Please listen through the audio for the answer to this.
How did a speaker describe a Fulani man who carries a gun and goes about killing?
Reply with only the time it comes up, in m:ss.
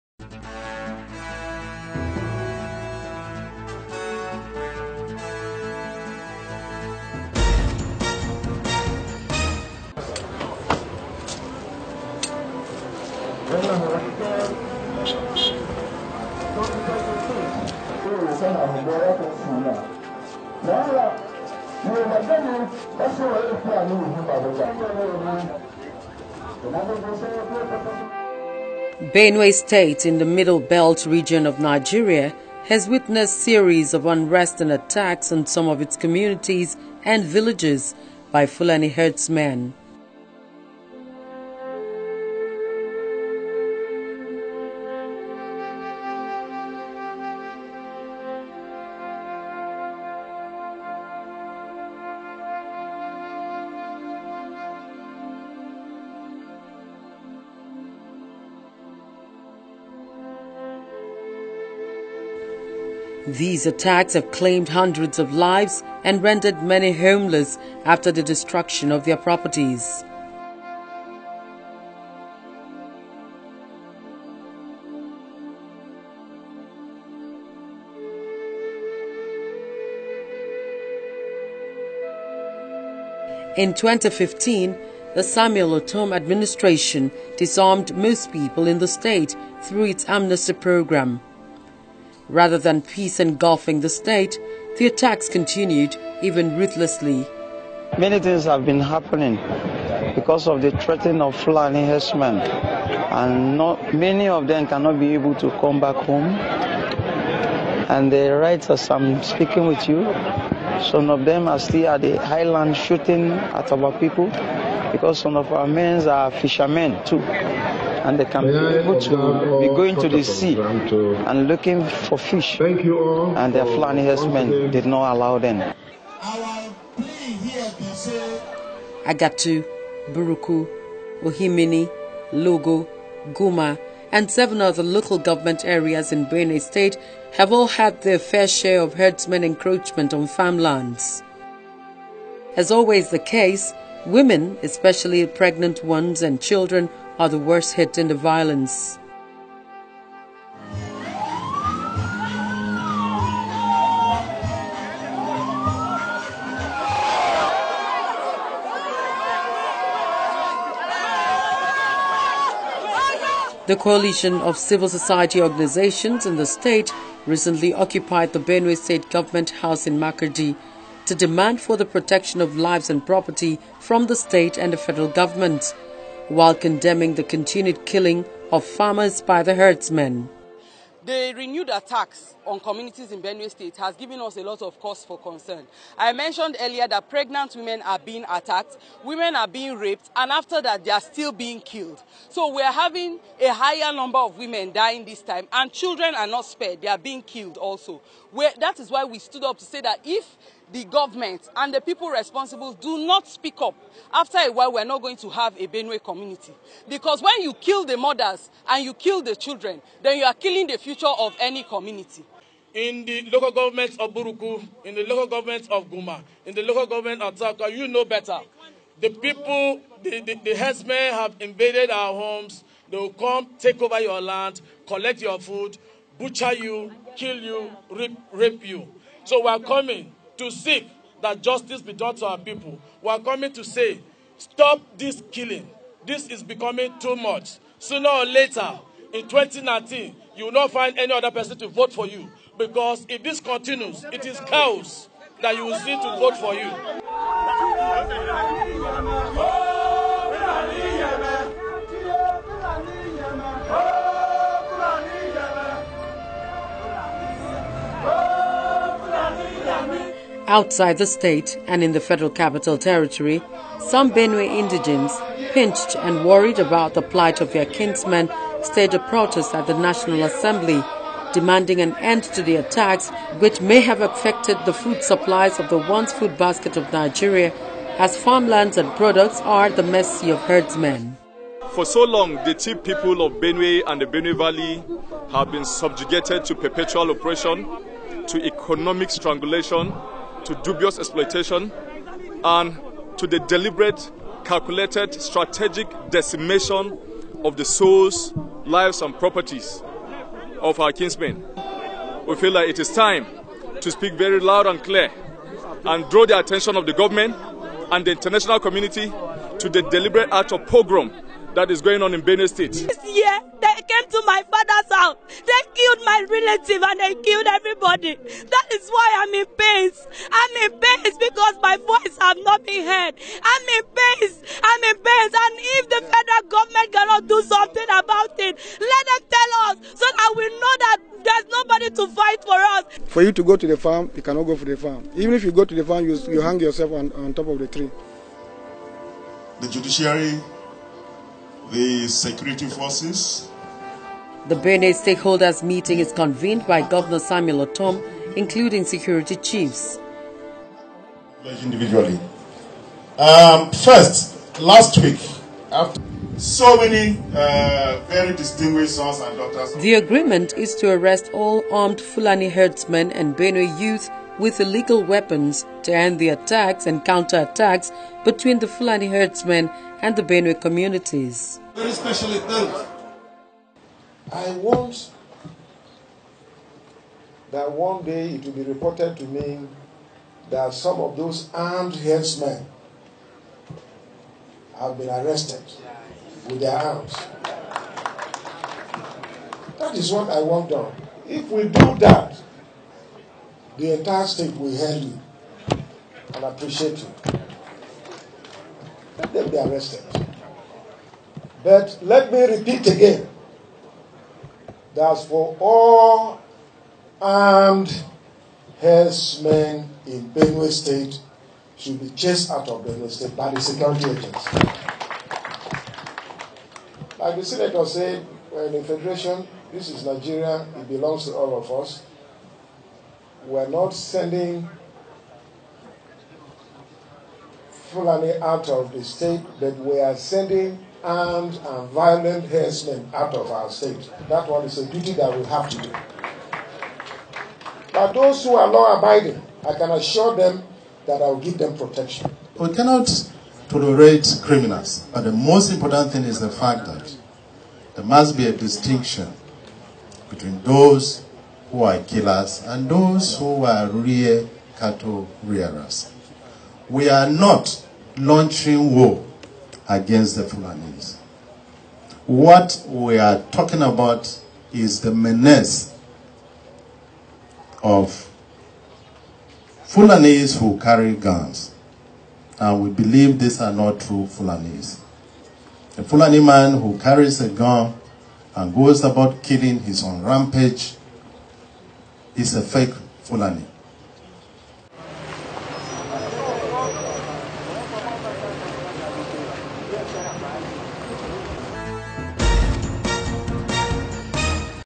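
8:02.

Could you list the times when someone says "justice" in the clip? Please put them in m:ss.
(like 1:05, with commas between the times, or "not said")
3:51.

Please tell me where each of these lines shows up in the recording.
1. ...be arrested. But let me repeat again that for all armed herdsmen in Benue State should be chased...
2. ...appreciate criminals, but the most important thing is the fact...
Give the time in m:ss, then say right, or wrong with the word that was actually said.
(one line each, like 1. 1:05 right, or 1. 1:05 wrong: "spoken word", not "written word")
1. 6:39 right
2. 7:23 wrong: "tolerate", not "appreciate".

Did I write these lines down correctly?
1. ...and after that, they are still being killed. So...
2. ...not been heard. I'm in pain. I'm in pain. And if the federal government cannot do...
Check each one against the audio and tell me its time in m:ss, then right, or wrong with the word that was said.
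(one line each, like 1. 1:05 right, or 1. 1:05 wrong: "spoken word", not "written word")
1. 3:10 right
2. 5:22 right.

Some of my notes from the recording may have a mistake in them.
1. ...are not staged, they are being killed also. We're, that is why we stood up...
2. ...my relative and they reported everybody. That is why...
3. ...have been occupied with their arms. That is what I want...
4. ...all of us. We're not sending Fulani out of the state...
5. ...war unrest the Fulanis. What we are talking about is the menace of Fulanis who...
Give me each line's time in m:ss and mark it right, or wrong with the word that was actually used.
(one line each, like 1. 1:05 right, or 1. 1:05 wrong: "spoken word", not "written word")
1. 3:16 wrong: "spared", not "staged"
2. 5:16 wrong: "killed", not "reported"
3. 6:24 wrong: "arrested", not "occupied"
4. 7:01 right
5. 7:38 wrong: "against", not "unrest".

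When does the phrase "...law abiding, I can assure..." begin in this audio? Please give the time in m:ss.
7:18.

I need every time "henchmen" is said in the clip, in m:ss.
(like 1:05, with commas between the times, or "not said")
7:12.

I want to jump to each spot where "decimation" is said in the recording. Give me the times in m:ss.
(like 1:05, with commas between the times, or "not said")
4:56.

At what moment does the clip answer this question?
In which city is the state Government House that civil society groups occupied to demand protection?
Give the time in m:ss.
2:49.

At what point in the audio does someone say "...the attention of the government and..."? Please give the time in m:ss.
5:06.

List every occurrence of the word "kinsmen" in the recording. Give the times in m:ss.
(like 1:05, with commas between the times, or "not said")
4:27, 5:00.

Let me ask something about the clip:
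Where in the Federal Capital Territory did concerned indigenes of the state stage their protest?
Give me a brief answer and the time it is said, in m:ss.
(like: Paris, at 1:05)
National Assembly, at 4:29.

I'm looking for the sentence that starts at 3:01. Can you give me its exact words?
The renewed attacks on communities in Benue State has given us a lot of cause for concern.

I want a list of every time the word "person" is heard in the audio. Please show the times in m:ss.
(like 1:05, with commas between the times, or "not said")
4:01.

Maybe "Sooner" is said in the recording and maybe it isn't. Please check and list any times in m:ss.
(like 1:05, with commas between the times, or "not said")
3:57.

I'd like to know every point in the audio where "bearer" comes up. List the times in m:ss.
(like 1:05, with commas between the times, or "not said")
not said.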